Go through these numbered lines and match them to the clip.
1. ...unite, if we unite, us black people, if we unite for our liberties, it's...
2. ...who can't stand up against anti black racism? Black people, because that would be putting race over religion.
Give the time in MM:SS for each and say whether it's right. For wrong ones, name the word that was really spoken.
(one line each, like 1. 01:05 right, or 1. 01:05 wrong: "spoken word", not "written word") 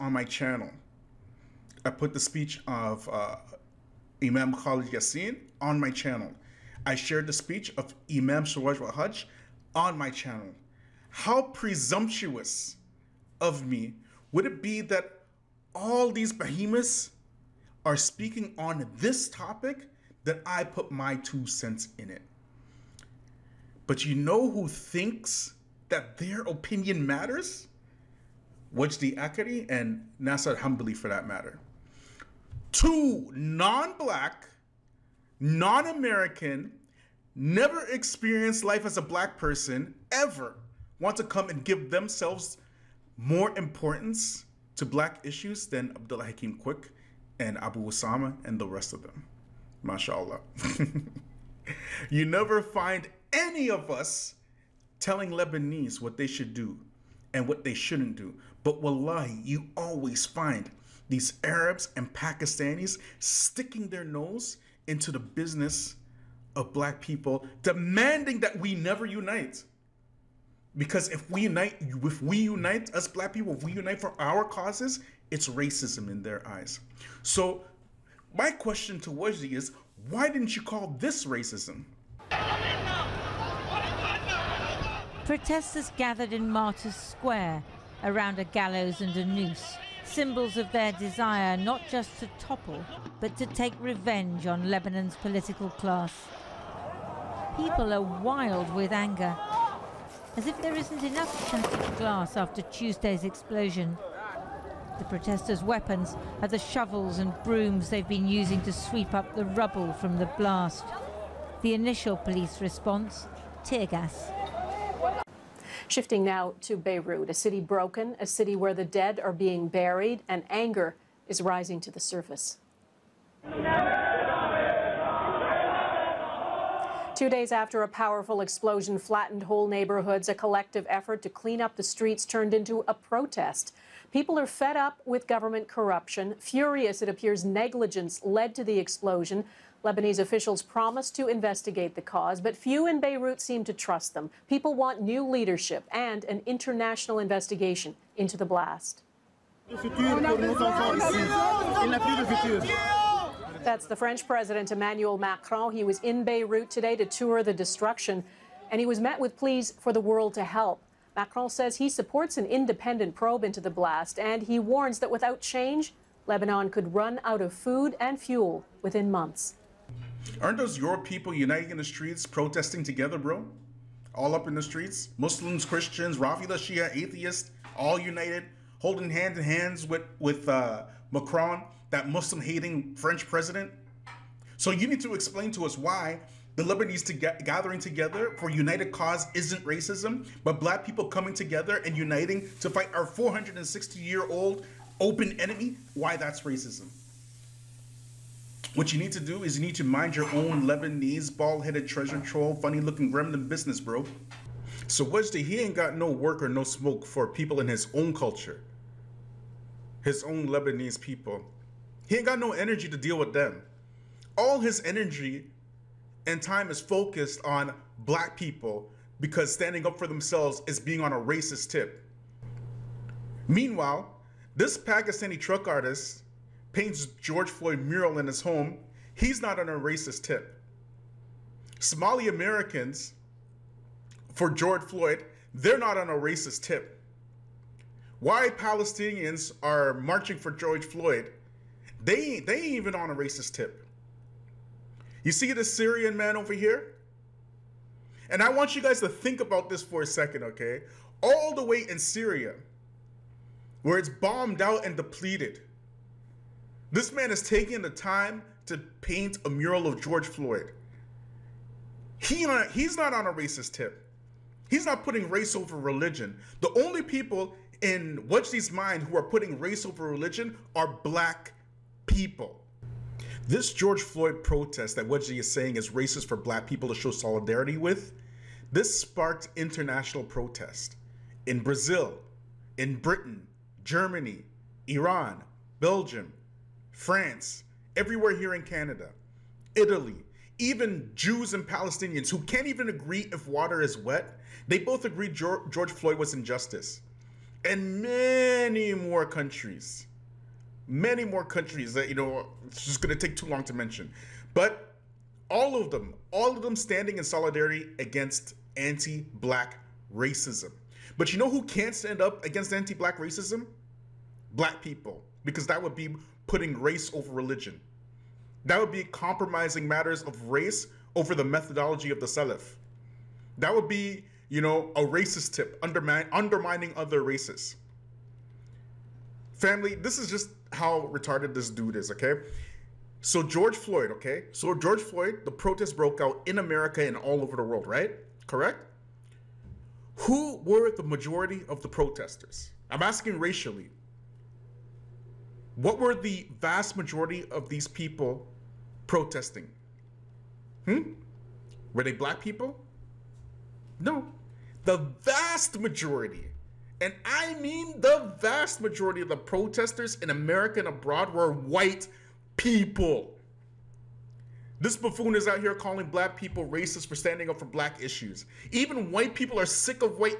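1. 01:11 wrong: "causes", not "liberties"
2. 05:11 right.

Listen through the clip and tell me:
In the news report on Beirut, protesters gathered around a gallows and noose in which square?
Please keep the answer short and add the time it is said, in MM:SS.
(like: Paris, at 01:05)
Martyrs Square, at 01:26.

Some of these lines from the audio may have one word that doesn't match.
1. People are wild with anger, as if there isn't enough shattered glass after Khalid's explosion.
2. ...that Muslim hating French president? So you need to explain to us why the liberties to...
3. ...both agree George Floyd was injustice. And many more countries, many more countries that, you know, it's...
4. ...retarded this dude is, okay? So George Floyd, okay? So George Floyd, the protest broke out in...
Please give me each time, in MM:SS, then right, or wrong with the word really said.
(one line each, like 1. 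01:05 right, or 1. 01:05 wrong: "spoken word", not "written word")
1. 01:37 wrong: "Tuesday", not "Khalid"
2. 03:01 right
3. 04:54 right
4. 05:31 right.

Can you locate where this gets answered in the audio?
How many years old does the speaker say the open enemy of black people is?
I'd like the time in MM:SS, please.
03:13.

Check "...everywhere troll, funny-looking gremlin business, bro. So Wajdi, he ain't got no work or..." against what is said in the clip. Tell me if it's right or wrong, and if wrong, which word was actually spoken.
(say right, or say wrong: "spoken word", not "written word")
wrong: "treasure", not "everywhere".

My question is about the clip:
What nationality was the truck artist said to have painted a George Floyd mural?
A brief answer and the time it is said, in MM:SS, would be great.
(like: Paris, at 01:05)
Pakistani, at 03:44.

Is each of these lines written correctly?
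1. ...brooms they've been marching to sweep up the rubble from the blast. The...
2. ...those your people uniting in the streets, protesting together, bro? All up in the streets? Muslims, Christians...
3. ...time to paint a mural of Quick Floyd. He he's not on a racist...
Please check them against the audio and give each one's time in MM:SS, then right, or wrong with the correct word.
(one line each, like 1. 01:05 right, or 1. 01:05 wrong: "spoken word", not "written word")
1. 01:47 wrong: "using", not "marching"
2. 02:50 right
3. 04:17 wrong: "George", not "Quick".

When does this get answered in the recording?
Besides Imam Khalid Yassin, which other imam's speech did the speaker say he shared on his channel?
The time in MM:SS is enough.
00:08.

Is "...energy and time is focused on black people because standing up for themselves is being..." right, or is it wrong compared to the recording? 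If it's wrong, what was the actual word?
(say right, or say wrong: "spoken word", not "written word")
right.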